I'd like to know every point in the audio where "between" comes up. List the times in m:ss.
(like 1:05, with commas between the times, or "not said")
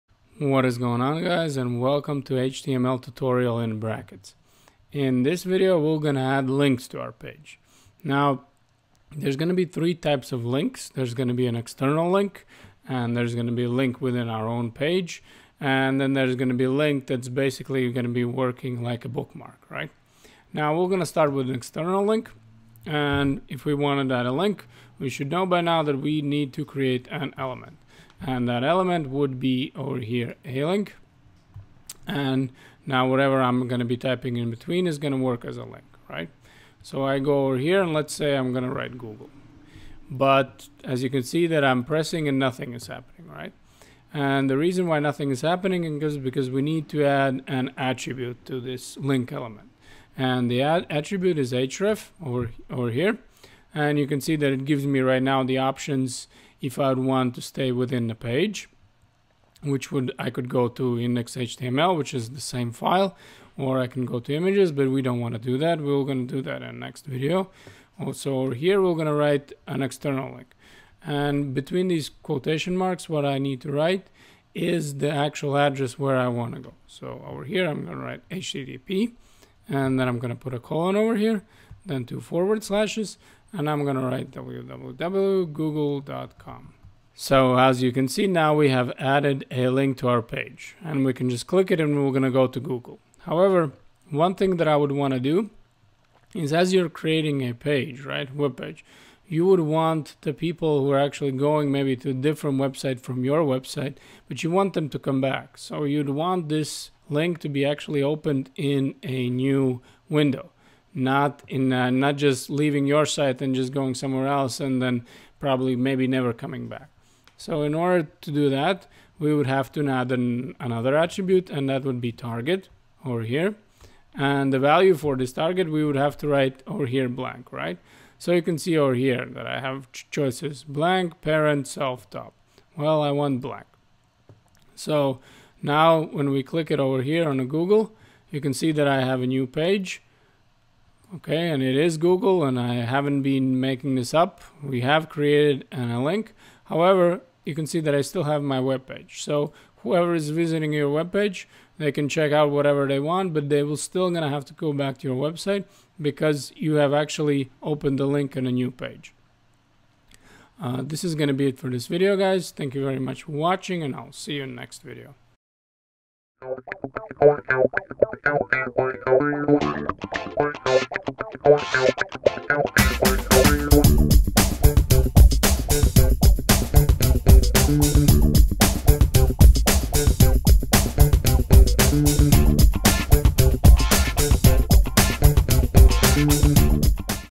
0:34, 1:11.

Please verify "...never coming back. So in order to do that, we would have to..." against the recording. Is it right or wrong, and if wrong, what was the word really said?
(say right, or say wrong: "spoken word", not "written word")
right.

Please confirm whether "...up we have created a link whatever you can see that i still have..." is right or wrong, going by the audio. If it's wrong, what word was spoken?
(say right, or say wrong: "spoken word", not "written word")
wrong: "however", not "whatever".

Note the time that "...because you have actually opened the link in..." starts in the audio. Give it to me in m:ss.
2:36.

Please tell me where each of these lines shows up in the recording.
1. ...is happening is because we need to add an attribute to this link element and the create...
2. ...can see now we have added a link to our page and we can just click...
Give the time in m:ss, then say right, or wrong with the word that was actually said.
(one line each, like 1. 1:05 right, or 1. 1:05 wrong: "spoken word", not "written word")
1. 0:45 wrong: "attribute", not "create"
2. 1:27 right.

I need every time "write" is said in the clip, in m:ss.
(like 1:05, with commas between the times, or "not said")
0:38, 1:09, 1:13, 1:18, 1:24, 2:06.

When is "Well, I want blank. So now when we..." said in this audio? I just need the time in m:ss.
2:12.